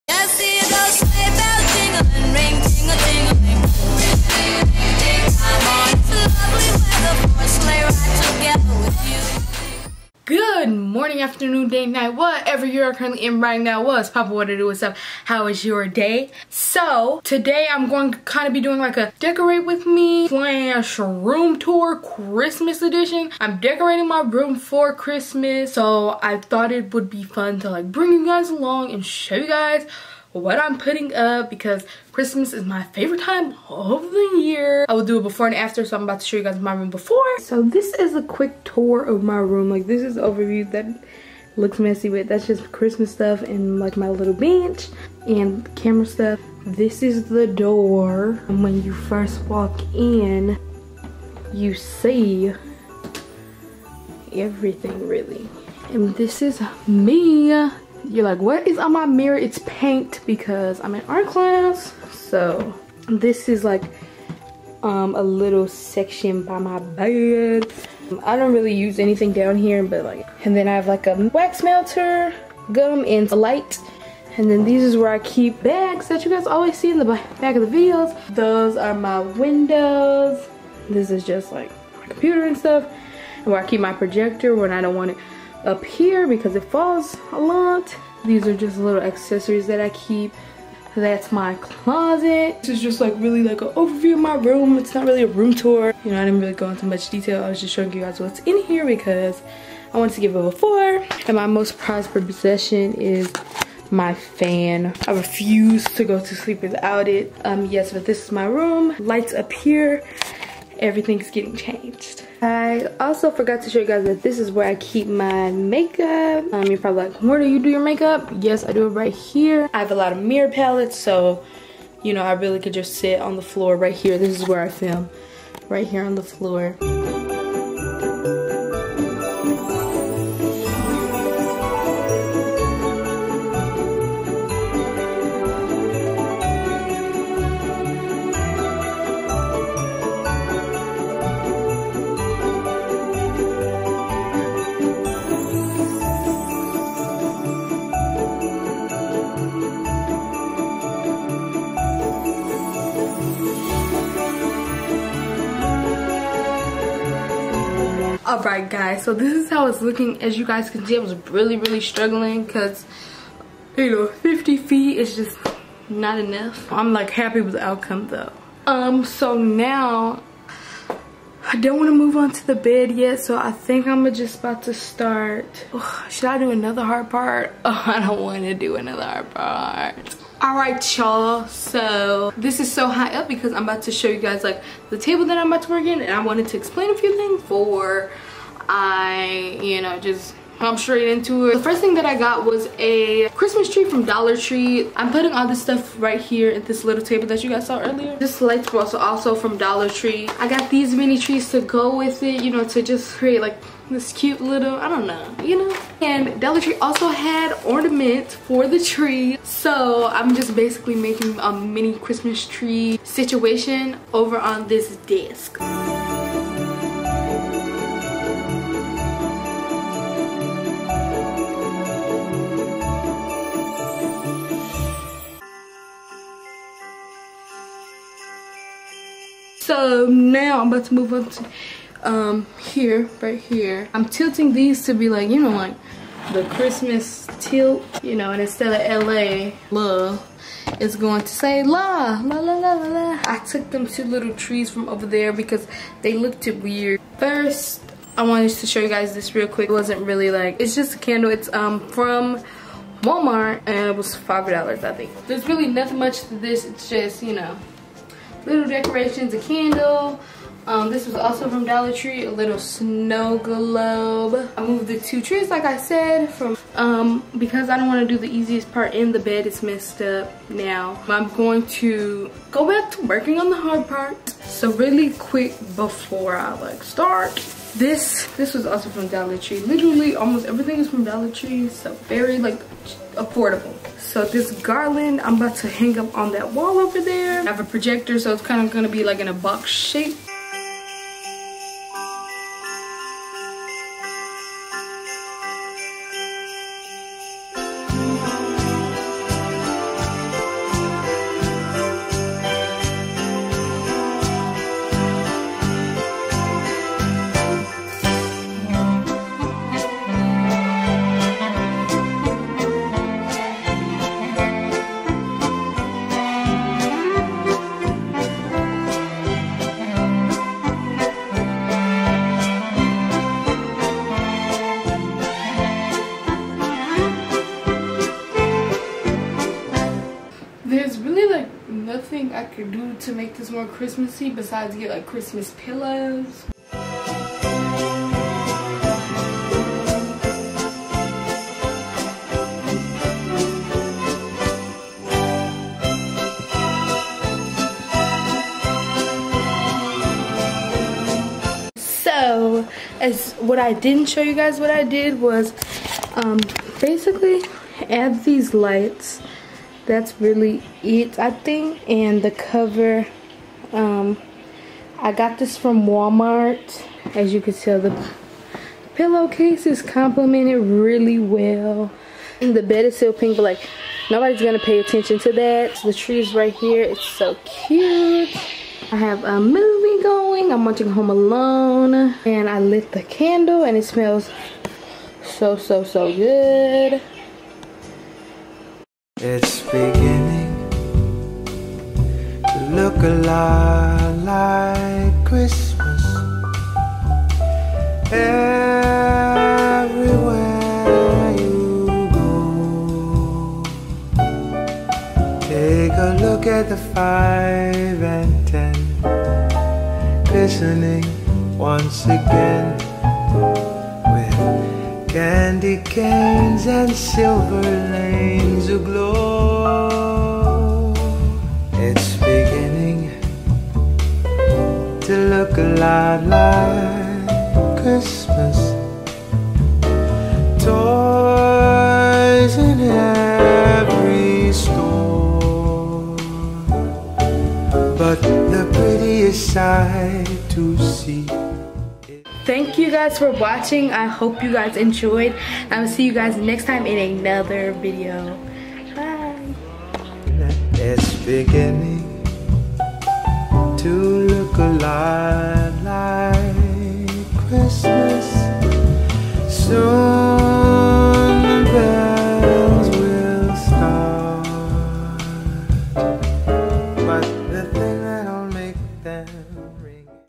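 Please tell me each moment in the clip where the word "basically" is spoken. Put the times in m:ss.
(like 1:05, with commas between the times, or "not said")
3:30, 5:56.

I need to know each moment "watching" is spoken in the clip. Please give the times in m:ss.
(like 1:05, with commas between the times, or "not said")
6:20, 7:23.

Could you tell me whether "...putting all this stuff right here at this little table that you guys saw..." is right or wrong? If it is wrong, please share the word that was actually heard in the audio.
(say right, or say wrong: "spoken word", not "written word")
right.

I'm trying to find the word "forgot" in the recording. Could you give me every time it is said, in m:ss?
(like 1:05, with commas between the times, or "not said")
1:53.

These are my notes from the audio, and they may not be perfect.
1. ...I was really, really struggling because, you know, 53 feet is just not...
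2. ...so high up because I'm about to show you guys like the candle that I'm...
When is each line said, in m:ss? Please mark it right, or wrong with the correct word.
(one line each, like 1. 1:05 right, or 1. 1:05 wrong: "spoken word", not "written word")
1. 2:40 wrong: "50", not "53"
2. 3:02 wrong: "table", not "candle".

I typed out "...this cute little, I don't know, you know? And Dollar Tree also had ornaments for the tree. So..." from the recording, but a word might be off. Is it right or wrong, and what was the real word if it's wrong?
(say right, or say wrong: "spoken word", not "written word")
right.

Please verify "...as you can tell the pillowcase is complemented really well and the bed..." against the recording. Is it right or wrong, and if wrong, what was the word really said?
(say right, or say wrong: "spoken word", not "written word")
right.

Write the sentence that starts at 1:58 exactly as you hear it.
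Yes, I do it right here.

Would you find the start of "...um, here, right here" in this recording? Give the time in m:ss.
3:52.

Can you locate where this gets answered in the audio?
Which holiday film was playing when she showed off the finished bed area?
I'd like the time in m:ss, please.
6:20.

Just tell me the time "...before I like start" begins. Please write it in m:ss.
4:35.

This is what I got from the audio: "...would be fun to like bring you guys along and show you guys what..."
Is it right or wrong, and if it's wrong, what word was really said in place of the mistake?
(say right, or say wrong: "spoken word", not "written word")
right.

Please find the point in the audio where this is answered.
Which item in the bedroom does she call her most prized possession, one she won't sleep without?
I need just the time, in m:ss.
1:44.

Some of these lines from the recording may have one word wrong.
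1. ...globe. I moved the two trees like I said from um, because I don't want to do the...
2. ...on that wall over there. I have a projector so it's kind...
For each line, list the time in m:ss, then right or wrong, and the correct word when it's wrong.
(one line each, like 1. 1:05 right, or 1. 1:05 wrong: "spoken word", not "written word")
1. 4:23 right
2. 4:46 right.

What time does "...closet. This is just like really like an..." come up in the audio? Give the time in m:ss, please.
1:31.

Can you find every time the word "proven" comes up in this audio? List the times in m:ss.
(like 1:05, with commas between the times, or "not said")
not said.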